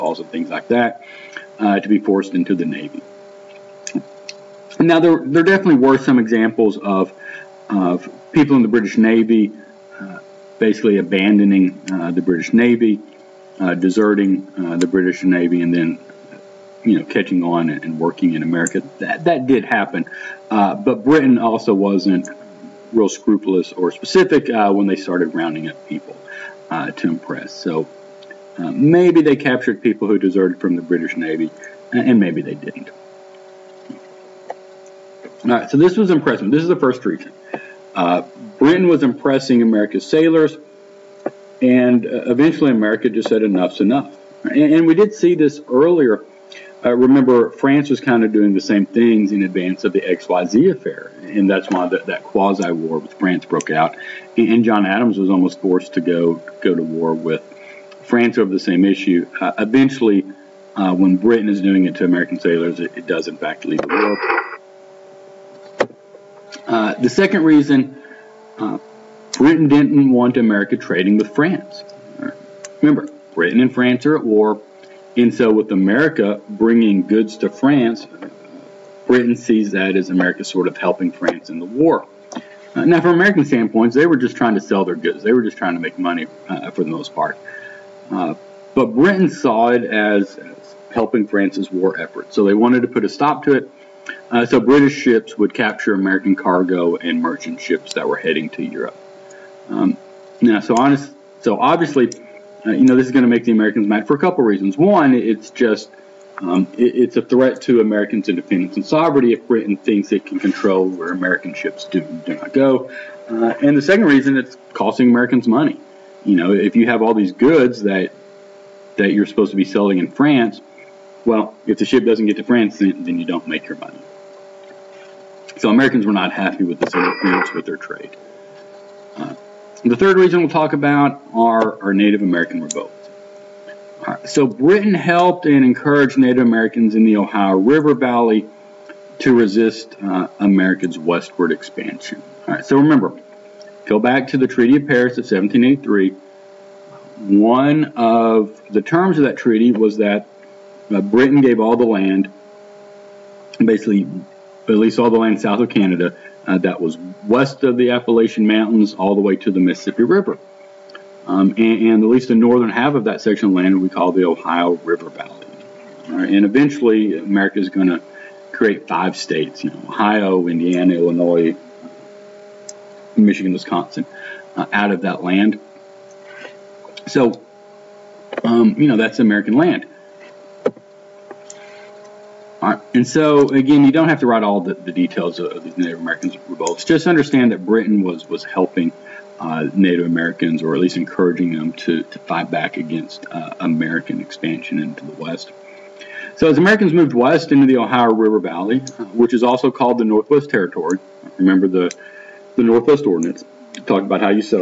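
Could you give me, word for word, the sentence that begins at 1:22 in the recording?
Uh, now, from American standpoints, they were just trying to sell their goods.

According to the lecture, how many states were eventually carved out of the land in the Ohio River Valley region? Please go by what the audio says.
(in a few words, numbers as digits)
5.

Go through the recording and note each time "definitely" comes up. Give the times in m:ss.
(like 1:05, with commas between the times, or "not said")
0:05.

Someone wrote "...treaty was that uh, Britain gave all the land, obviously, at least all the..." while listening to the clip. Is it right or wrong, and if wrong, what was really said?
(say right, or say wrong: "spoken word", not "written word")
wrong: "basically", not "obviously".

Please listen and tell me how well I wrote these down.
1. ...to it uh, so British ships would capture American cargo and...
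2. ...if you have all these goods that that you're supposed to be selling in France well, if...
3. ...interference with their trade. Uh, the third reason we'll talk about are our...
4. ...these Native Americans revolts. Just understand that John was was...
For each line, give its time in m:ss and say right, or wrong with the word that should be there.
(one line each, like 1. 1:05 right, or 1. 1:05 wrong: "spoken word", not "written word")
1. 1:33 right
2. 1:56 right
3. 2:06 right
4. 3:05 wrong: "Britain", not "John".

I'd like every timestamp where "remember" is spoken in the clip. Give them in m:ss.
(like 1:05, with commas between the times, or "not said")
0:46, 1:12, 2:22, 3:21.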